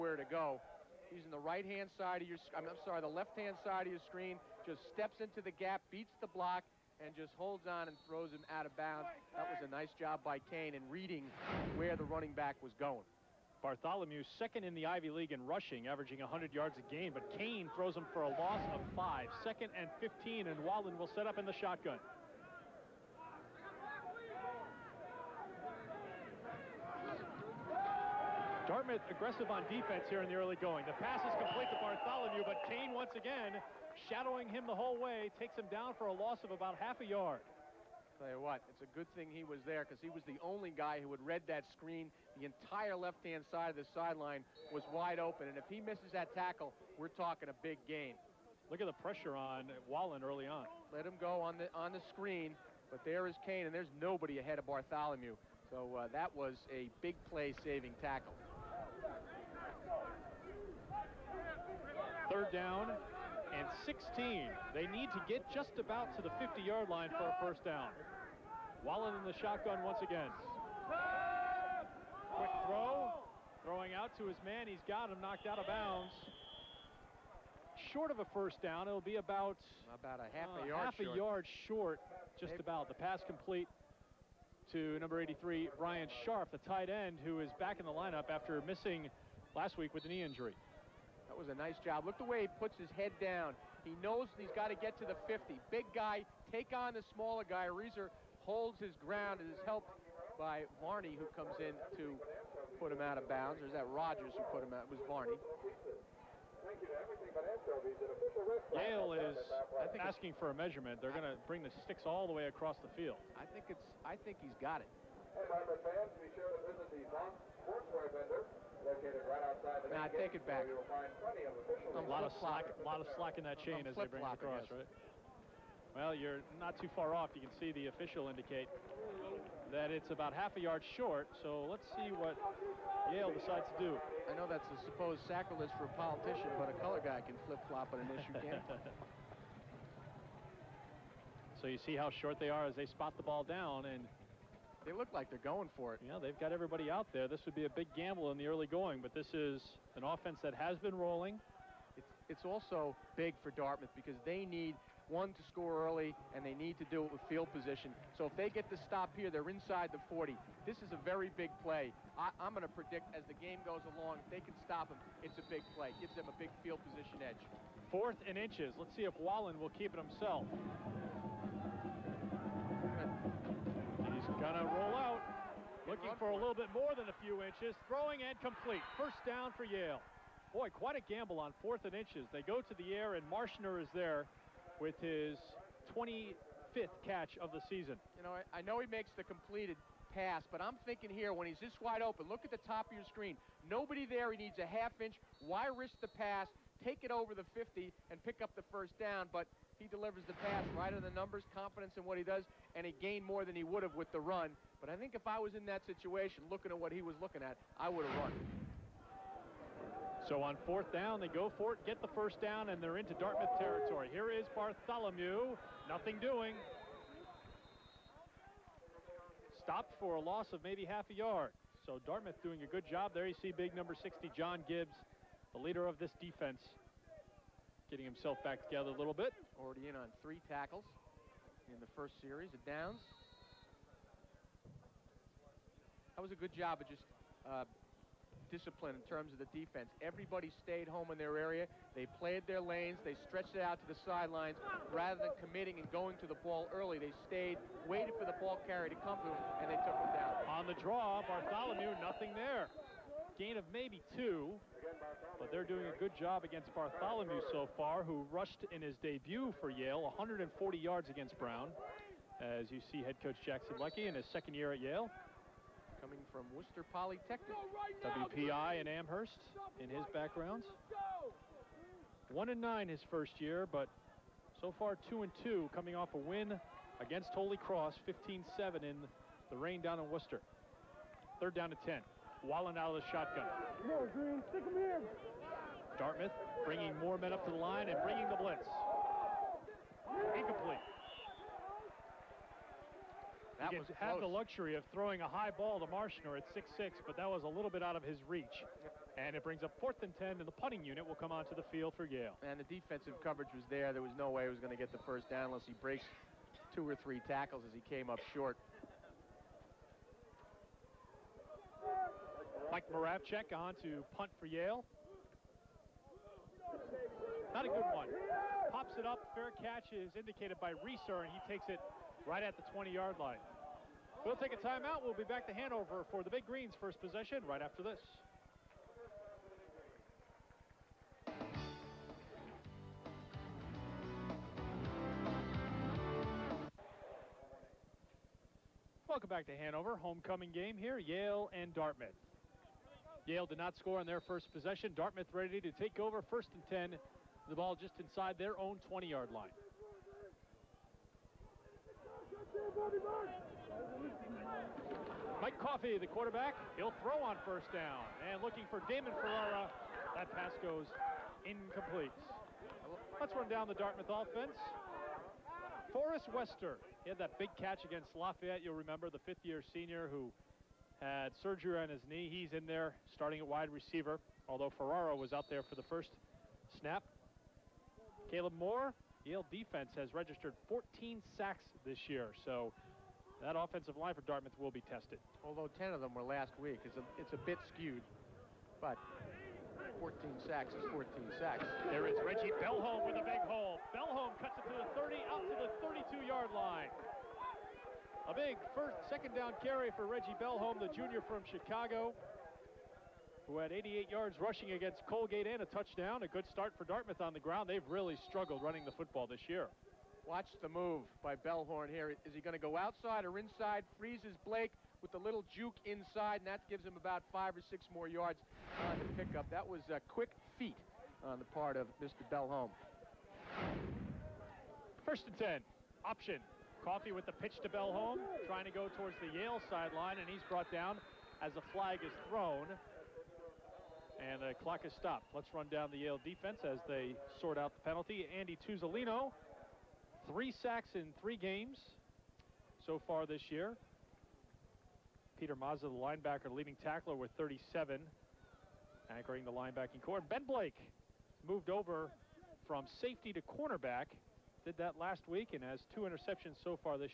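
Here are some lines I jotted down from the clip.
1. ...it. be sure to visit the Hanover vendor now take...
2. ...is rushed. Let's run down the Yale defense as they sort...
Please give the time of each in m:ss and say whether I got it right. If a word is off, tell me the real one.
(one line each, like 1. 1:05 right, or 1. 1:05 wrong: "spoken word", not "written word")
1. 1:54 wrong: "Sportswear", not "Hanover"
2. 7:14 wrong: "stopped", not "rushed".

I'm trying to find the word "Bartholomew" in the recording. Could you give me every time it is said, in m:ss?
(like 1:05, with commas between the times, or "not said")
0:13, 0:31, 0:54, 3:34, 4:11, 4:16.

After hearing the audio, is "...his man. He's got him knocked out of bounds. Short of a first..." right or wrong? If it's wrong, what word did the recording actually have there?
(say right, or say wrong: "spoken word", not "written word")
right.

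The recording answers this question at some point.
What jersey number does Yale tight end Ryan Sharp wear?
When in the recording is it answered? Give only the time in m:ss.
1:24.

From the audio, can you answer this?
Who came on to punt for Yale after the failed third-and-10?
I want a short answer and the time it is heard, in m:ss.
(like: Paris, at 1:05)
Mike Moravchek, at 5:12.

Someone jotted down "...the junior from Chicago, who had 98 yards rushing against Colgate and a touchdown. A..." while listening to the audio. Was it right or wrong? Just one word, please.
wrong.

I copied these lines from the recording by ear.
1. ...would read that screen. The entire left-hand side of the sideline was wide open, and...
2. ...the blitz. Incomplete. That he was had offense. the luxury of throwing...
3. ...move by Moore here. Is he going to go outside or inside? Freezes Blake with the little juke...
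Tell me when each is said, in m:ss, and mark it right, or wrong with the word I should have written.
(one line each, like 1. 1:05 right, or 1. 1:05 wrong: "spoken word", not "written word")
1. 0:41 right
2. 4:48 wrong: "close", not "offense"
3. 6:50 wrong: "Bellhorn", not "Moore".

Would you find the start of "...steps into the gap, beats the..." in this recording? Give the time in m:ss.
0:04.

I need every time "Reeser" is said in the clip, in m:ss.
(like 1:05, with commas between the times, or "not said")
1:37, 5:20.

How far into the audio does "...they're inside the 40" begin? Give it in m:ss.
2:39.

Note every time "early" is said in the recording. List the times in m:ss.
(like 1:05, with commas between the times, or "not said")
0:30, 0:50, 2:28, 2:35, 4:06.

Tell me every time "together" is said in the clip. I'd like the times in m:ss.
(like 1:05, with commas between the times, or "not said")
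3:48.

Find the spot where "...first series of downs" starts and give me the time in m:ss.
3:51.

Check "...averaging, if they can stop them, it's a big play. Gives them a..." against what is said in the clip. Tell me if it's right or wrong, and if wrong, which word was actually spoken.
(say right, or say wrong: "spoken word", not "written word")
wrong: "along", not "averaging".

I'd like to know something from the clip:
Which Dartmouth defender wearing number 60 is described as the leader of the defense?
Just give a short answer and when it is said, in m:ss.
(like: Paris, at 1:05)
John Gibbs, at 3:44.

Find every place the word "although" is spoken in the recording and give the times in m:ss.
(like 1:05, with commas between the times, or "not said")
6:14, 6:25.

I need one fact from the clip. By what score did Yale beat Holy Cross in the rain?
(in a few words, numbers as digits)
15-7.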